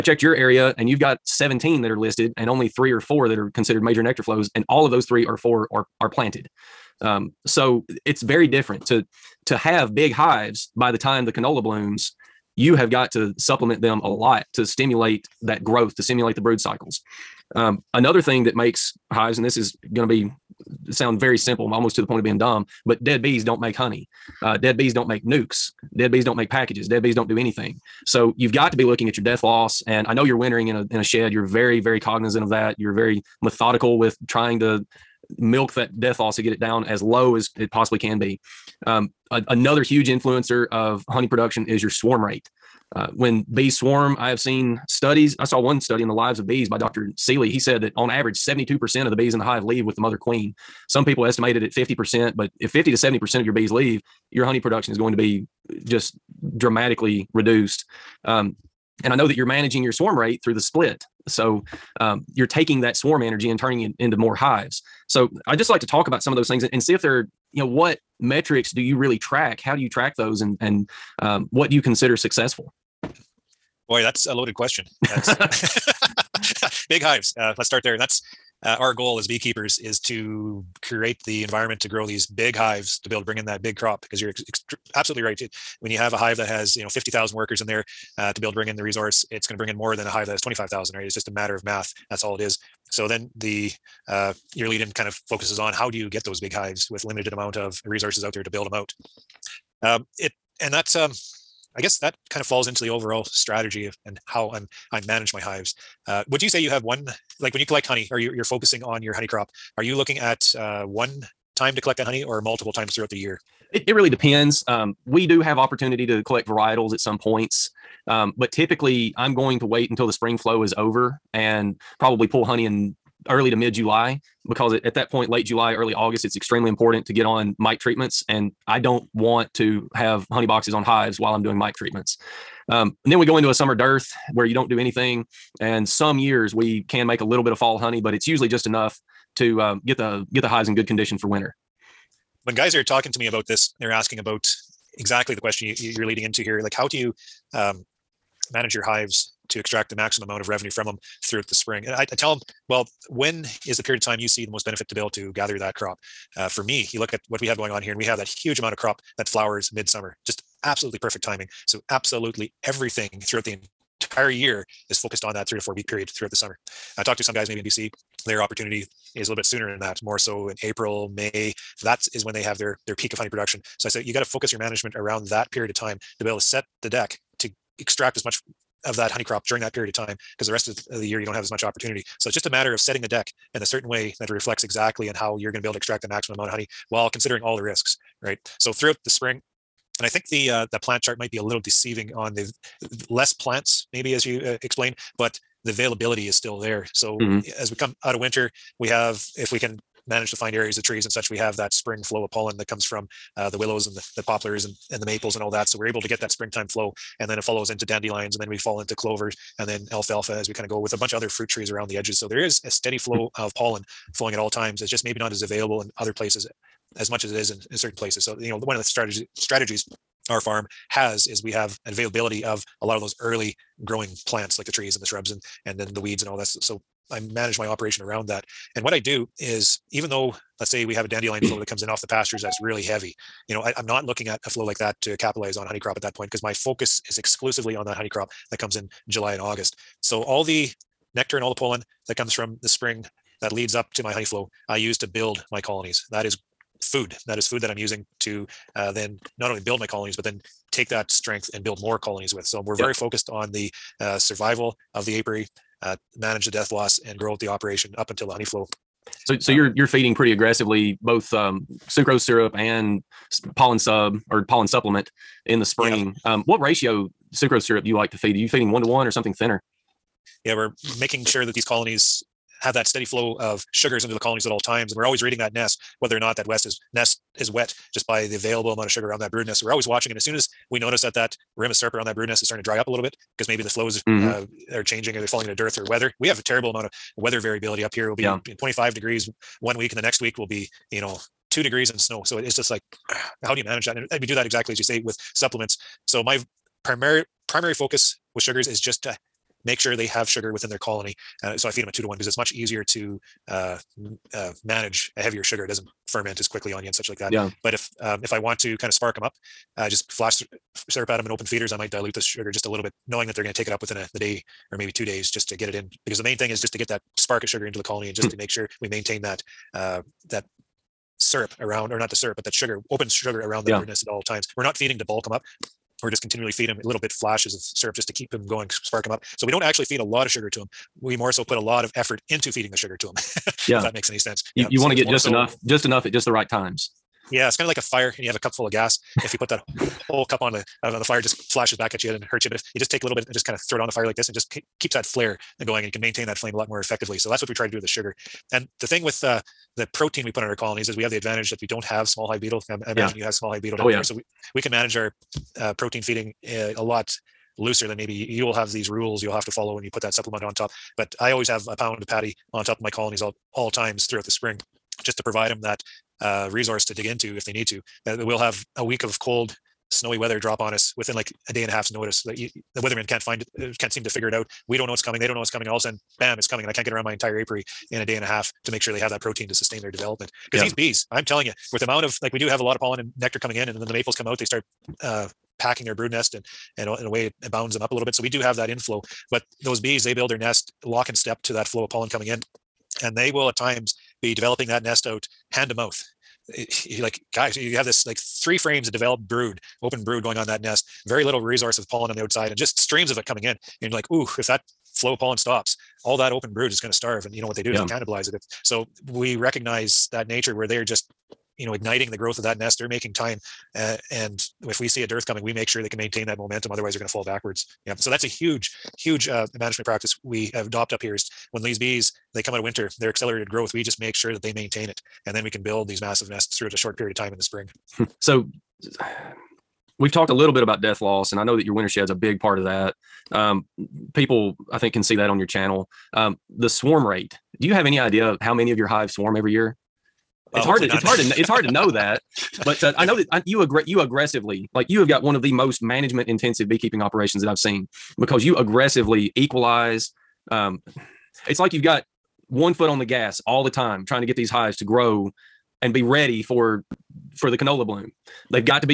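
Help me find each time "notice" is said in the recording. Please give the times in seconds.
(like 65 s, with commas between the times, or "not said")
280 s, 371 s.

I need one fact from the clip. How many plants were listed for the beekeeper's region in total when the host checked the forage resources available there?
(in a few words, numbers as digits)
17.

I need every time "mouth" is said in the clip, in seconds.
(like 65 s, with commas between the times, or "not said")
395 s.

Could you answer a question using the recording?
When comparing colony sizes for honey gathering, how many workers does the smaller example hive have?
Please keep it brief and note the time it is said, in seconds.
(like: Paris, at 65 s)
25000, at 90 s.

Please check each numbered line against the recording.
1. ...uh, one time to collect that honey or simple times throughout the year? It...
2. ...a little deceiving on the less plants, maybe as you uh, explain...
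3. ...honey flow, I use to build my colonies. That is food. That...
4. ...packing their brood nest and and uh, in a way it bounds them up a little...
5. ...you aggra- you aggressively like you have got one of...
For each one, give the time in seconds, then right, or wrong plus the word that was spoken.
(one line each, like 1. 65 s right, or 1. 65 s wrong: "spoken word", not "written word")
1. 110 s wrong: "multiple", not "simple"
2. 191 s right
3. 244 s right
4. 385 s right
5. 443 s right.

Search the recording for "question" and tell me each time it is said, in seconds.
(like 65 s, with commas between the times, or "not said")
74 s, 145 s.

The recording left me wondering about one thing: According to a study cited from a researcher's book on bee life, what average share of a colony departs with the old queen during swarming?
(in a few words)
72%.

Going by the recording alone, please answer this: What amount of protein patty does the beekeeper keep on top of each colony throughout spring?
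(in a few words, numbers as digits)
A pound.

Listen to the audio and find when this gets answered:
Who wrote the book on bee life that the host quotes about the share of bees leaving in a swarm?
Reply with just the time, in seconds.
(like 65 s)
46 s.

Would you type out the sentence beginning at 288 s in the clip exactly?
25 degrees one week, and the next week will be you know two degrees and snow.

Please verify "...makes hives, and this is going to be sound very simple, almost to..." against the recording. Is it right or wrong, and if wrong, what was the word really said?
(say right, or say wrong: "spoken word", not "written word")
right.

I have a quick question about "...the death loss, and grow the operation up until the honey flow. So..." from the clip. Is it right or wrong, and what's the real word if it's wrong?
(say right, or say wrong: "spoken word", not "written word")
right.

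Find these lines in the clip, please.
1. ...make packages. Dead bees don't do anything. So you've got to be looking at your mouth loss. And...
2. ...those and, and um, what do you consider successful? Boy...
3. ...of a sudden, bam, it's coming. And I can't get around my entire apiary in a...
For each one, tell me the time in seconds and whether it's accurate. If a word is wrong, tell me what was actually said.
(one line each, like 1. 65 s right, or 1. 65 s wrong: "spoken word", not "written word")
1. 26 s wrong: "death", not "mouth"
2. 70 s right
3. 375 s right.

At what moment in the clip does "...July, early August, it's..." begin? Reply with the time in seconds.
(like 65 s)
125 s.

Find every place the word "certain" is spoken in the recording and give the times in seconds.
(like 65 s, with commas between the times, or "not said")
183 s, 217 s.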